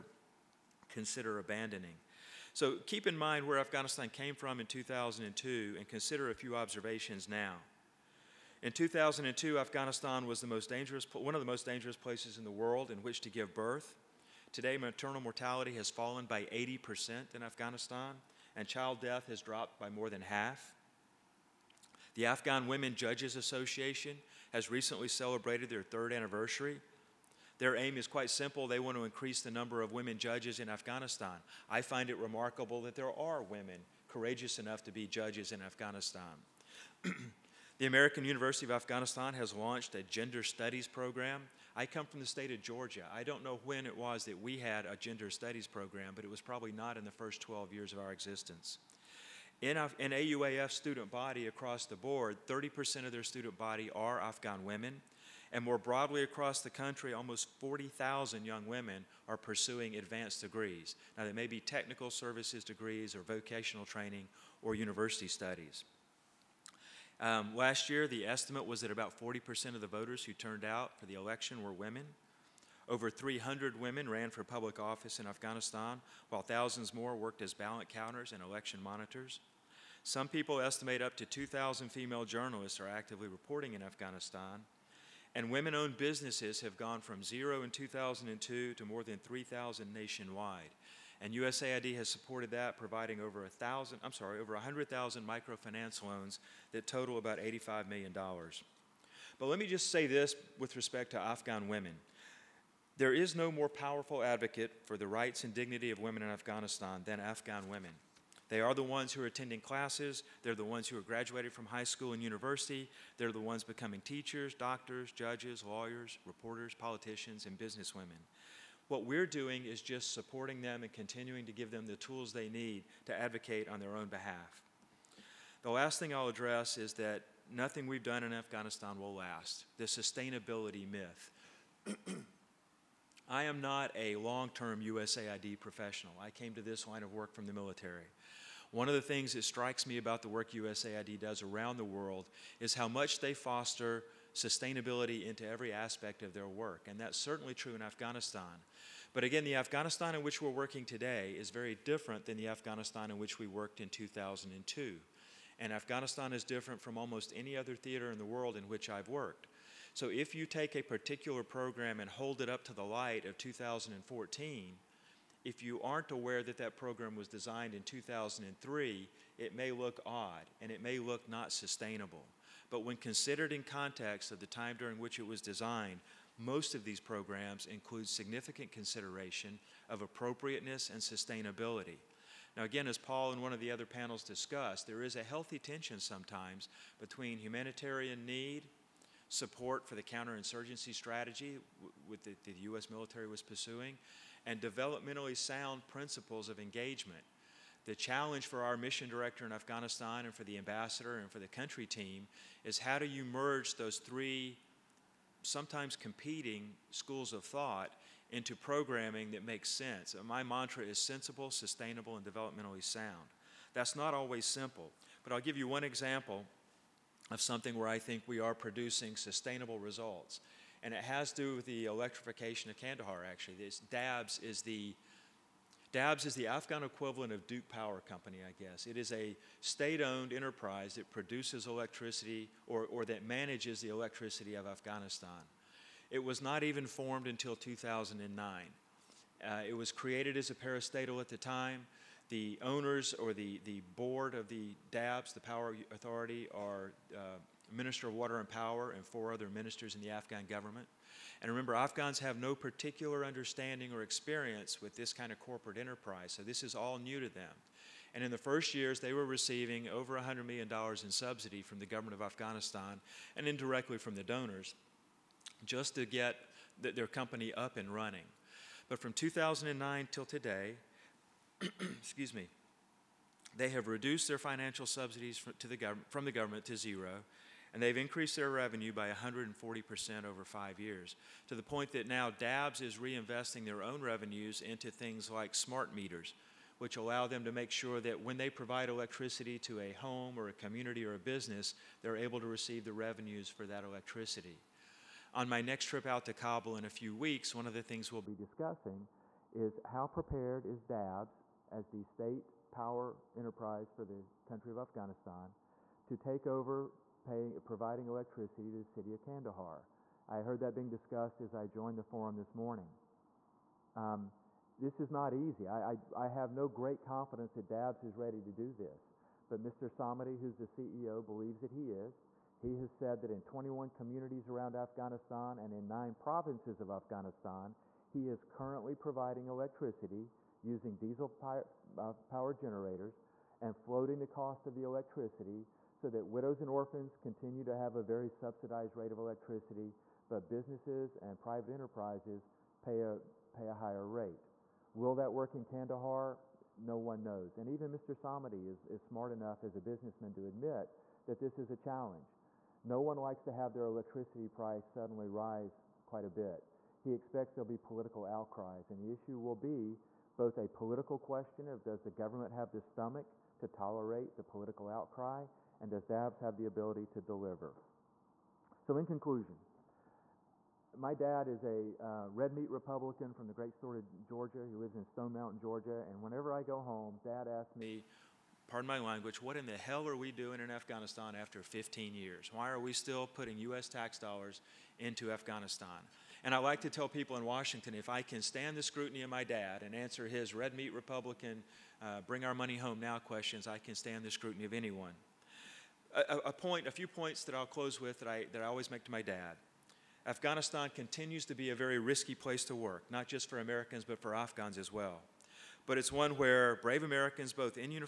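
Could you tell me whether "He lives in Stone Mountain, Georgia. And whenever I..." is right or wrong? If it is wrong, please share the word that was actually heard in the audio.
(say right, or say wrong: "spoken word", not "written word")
right.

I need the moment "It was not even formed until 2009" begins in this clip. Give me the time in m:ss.
3:56.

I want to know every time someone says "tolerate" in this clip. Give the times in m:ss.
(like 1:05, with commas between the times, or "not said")
6:03.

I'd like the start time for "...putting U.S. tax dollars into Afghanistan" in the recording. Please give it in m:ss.
6:23.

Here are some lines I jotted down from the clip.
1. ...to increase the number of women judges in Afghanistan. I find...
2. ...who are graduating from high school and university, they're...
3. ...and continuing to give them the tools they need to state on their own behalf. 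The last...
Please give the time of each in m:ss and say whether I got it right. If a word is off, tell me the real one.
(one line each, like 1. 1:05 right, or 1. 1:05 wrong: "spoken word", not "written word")
1. 0:28 right
2. 1:50 right
3. 2:00 wrong: "advocate", not "state".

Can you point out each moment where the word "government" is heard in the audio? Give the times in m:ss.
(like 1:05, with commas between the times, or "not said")
4:10, 4:21, 4:36, 6:02.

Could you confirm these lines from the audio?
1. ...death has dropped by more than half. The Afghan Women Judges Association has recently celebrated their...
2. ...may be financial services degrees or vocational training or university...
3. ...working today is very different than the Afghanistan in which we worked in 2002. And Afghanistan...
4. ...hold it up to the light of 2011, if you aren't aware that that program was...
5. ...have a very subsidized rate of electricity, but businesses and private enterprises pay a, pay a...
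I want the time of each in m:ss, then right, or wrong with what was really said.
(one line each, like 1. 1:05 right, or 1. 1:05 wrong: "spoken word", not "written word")
1. 0:19 right
2. 1:01 wrong: "technical", not "financial"
3. 2:30 right
4. 2:42 wrong: "2014", not "2011"
5. 5:37 right.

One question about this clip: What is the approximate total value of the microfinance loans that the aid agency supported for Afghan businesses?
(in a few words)
$85 million.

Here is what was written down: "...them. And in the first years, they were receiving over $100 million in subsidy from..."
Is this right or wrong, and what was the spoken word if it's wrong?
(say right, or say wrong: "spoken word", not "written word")
right.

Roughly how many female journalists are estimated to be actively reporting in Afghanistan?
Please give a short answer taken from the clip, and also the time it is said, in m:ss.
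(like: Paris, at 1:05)
2,000, at 1:21.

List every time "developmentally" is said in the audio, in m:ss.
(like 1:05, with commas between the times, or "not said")
3:14, 3:32.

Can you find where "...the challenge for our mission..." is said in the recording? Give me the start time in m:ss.
3:17.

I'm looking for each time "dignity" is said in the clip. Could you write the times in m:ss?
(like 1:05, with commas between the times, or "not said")
1:45.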